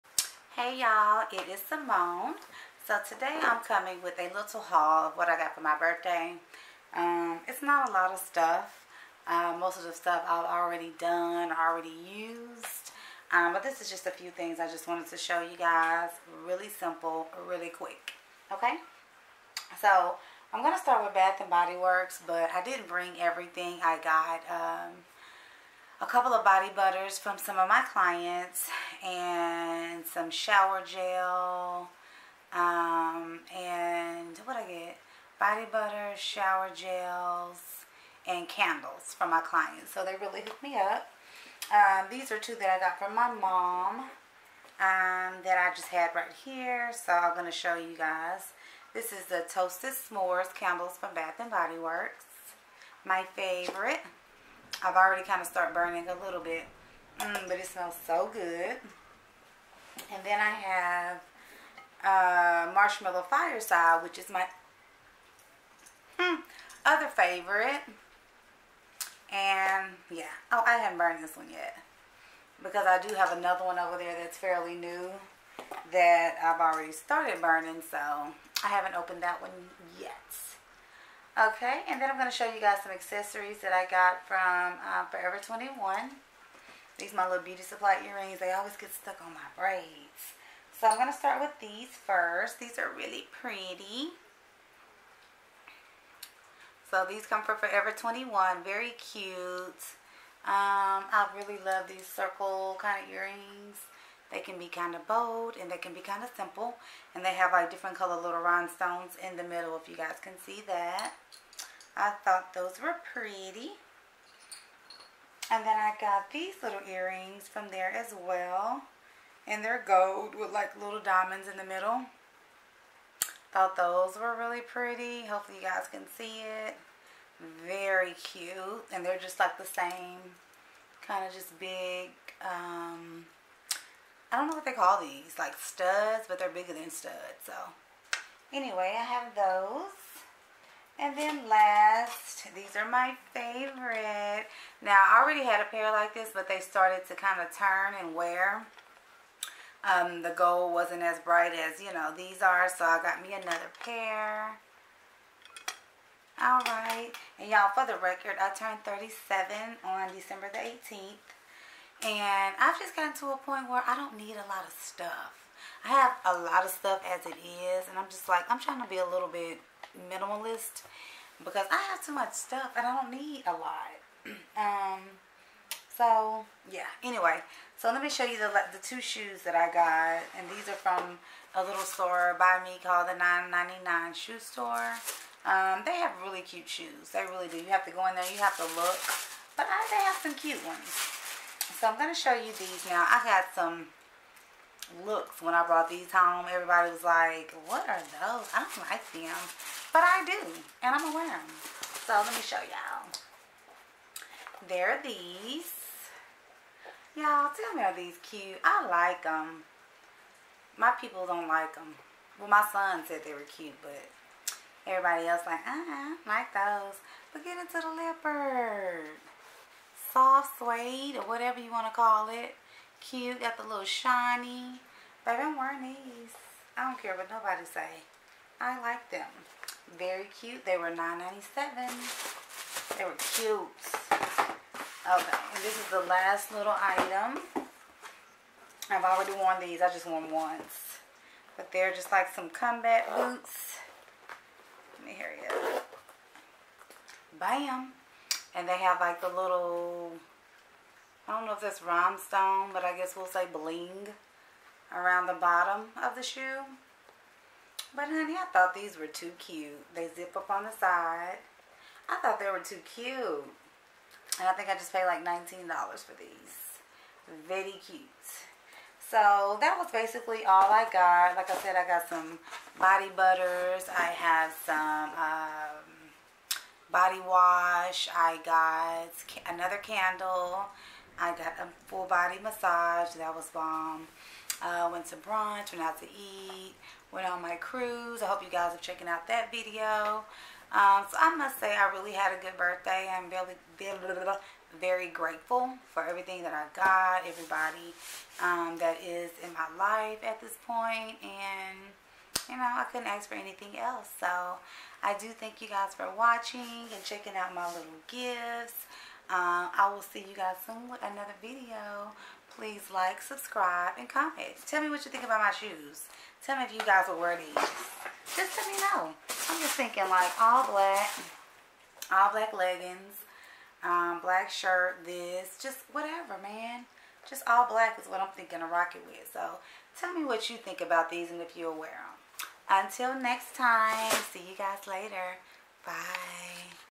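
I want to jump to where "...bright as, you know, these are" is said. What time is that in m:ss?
2:31.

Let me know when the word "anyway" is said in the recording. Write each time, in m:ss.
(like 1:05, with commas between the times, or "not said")
2:18, 2:57.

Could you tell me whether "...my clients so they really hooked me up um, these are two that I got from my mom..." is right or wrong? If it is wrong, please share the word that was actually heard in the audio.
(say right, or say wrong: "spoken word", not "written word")
right.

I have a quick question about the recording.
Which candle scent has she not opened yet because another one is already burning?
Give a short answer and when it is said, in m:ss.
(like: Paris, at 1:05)
Marshmallow Fireside, at 1:02.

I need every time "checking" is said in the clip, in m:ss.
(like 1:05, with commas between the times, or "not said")
4:48, 5:07.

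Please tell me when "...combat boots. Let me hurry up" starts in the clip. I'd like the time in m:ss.
4:02.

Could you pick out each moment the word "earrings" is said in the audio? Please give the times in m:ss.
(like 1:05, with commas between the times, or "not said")
1:28, 1:43, 1:56.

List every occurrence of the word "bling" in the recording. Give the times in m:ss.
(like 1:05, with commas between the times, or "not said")
4:13.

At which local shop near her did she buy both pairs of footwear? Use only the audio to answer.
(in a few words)
999 Shoe Store.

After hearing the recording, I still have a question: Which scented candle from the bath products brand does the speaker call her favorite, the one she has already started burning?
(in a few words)
Toasted S'mores.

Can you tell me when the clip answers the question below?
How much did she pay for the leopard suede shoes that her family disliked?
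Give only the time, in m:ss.
3:50.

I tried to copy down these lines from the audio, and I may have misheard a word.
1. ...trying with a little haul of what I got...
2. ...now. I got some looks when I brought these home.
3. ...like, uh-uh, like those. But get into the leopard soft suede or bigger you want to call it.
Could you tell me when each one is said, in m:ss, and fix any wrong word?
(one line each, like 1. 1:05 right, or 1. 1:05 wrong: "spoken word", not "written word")
1. 0:03 wrong: "coming", not "trying"
2. 3:12 right
3. 3:35 wrong: "whatever", not "bigger".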